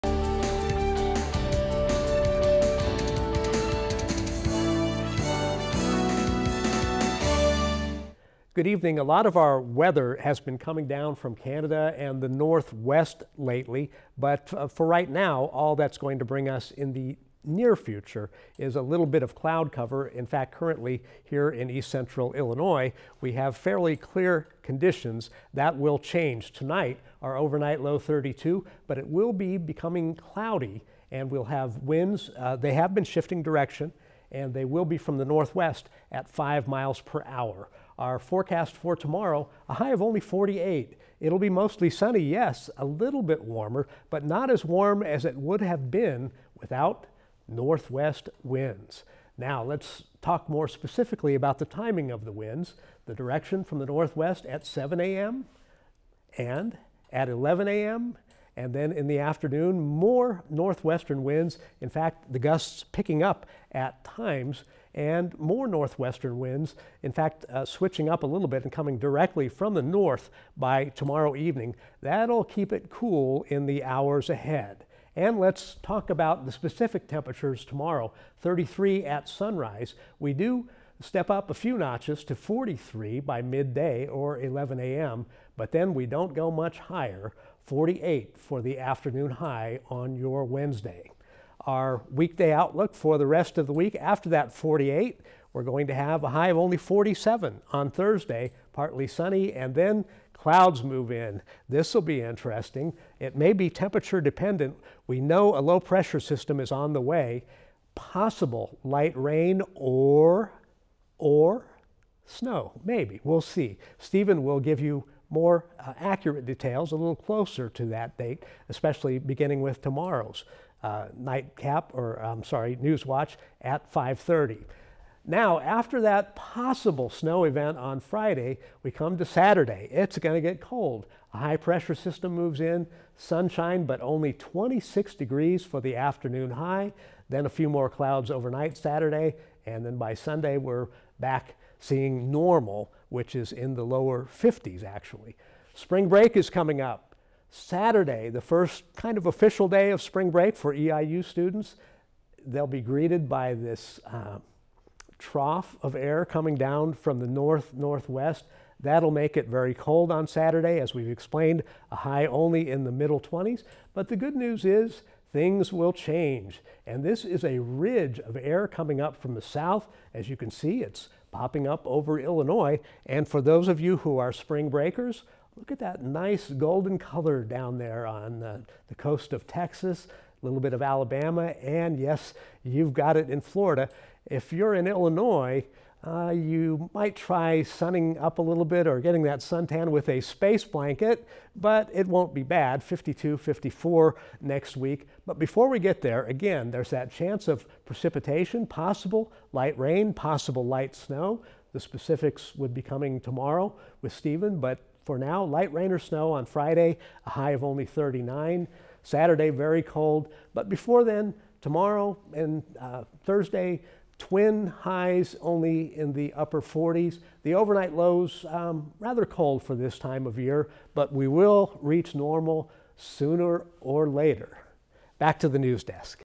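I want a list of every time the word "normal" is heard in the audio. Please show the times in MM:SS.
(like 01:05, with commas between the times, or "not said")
02:22, 03:42.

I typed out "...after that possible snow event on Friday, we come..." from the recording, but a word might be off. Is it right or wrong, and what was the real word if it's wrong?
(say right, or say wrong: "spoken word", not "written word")
right.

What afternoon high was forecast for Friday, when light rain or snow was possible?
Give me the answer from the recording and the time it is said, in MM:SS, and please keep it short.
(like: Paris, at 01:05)
39, at 03:27.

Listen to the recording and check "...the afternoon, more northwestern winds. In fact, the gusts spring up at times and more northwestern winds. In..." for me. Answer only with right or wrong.
wrong.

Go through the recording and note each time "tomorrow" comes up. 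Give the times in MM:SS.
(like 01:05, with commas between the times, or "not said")
00:38, 01:10, 01:17, 01:59, 03:23, 03:31.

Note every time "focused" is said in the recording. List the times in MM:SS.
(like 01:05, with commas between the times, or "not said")
not said.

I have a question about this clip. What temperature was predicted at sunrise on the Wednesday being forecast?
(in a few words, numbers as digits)
33.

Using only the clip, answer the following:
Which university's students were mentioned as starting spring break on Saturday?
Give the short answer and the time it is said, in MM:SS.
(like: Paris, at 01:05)
EIU, at 02:30.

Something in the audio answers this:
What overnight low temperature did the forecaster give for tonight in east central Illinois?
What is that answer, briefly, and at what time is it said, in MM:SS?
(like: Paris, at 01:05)
32, at 00:27.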